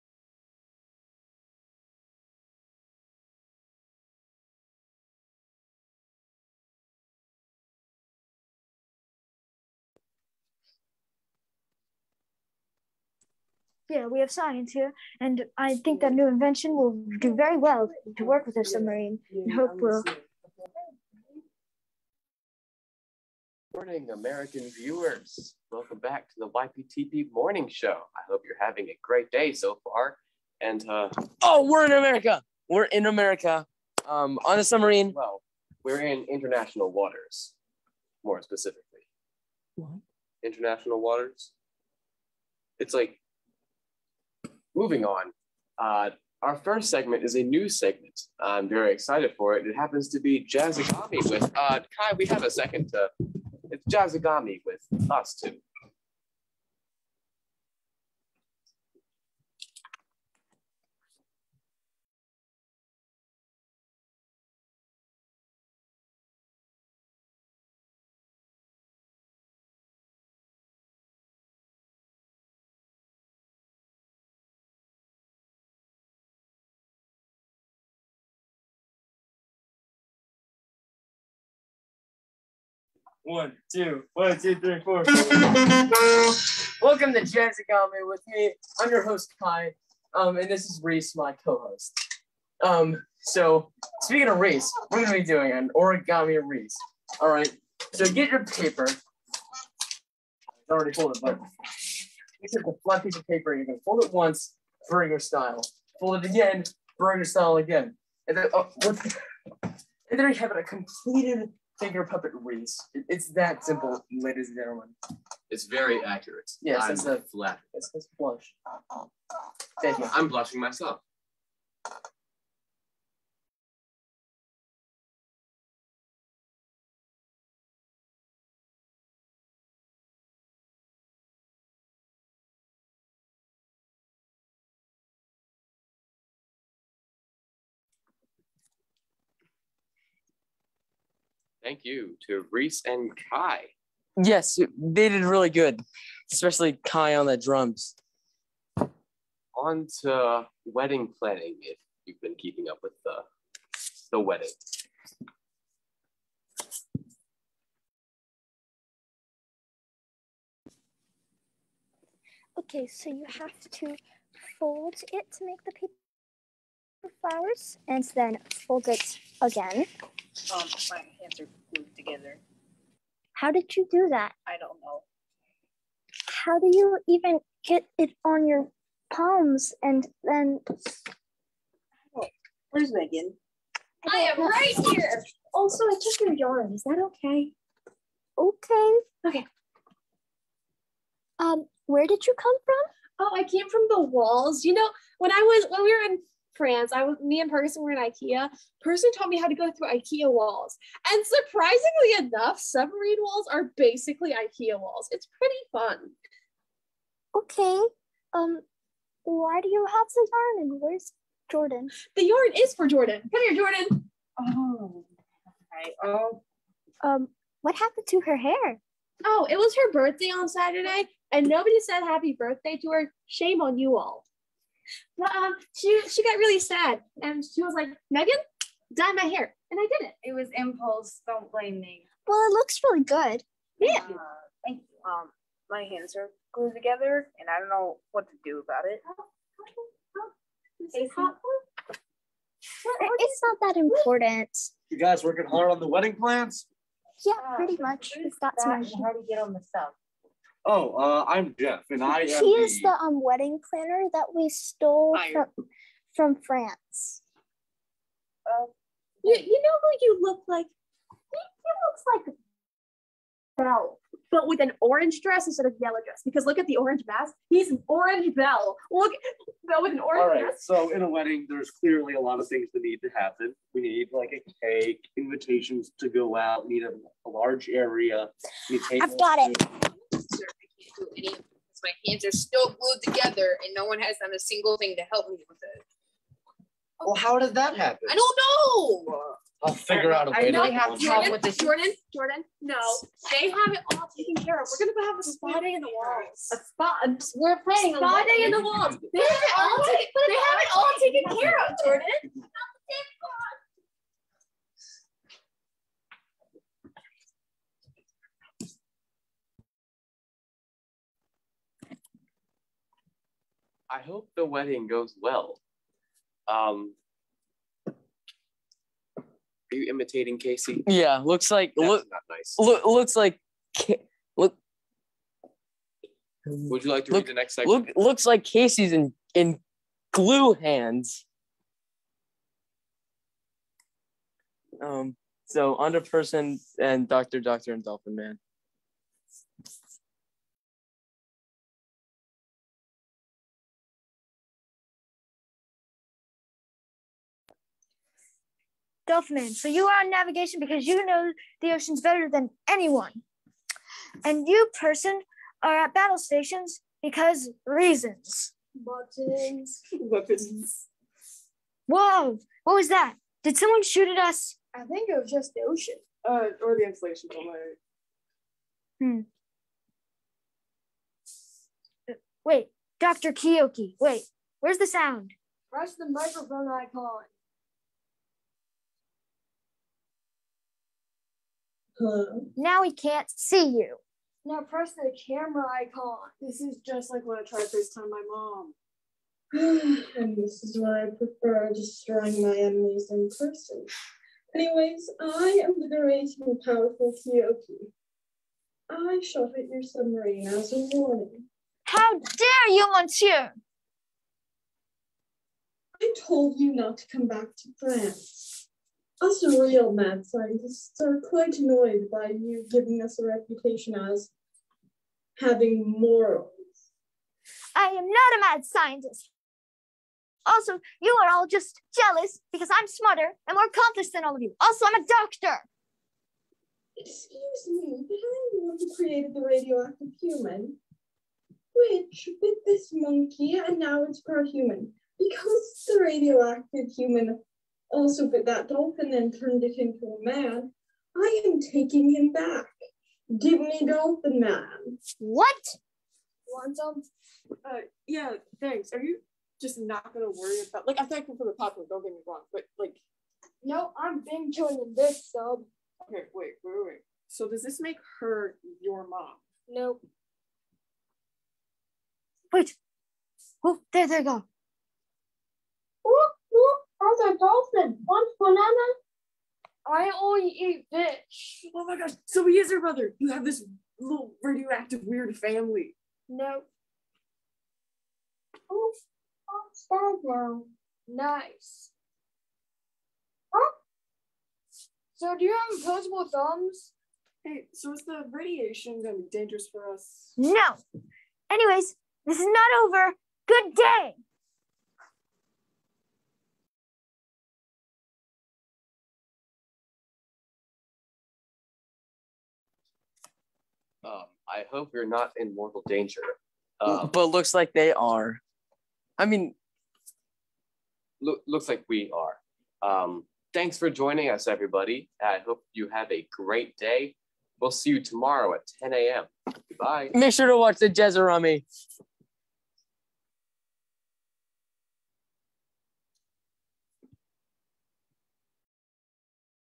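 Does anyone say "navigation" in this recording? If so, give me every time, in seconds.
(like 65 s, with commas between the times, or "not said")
350 s.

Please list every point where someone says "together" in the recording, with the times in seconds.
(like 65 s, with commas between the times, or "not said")
171 s, 236 s, 283 s.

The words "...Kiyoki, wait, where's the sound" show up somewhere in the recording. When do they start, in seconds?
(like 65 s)
373 s.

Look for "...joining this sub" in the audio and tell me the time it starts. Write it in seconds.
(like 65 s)
454 s.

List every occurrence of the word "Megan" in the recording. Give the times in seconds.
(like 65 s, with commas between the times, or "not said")
182 s, 228 s.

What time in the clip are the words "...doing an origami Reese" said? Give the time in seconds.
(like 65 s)
95 s.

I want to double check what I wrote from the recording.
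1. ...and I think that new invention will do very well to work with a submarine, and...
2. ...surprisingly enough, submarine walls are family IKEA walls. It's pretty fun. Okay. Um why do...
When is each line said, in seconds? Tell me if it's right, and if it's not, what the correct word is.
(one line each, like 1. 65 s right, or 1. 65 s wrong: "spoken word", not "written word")
1. 15 s right
2. 201 s wrong: "basically", not "family".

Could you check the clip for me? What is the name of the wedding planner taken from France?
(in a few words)
Jeff.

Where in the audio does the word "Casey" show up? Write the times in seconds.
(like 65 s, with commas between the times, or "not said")
320 s, 328 s.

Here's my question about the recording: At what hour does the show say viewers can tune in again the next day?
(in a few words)
10 a.m.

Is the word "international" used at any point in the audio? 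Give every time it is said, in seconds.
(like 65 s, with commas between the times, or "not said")
36 s, 40 s.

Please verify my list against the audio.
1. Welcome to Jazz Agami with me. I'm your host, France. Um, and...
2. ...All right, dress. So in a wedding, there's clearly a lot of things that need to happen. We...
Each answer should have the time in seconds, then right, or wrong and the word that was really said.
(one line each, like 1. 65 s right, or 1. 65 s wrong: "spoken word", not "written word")
1. 86 s wrong: "Kai", not "France"
2. 270 s right.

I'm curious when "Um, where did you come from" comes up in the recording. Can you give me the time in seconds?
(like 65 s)
191 s.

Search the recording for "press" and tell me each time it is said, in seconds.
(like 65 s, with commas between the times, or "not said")
375 s, 384 s.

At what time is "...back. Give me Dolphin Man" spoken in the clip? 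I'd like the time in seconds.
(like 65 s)
442 s.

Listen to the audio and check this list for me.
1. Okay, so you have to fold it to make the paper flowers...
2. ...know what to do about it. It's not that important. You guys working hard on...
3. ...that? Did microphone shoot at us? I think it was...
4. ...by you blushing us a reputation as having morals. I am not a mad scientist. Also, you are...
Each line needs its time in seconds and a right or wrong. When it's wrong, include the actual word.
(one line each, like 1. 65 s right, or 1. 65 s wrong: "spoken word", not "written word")
1. 162 s right
2. 237 s right
3. 362 s wrong: "someone", not "microphone"
4. 412 s wrong: "giving", not "blushing".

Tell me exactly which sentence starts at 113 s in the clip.
it's that simple, ladies and gentlemen.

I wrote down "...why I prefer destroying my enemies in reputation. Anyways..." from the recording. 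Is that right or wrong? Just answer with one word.
wrong.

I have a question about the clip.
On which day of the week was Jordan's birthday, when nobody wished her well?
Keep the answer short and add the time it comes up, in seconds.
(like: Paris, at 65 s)
Saturday, at 220 s.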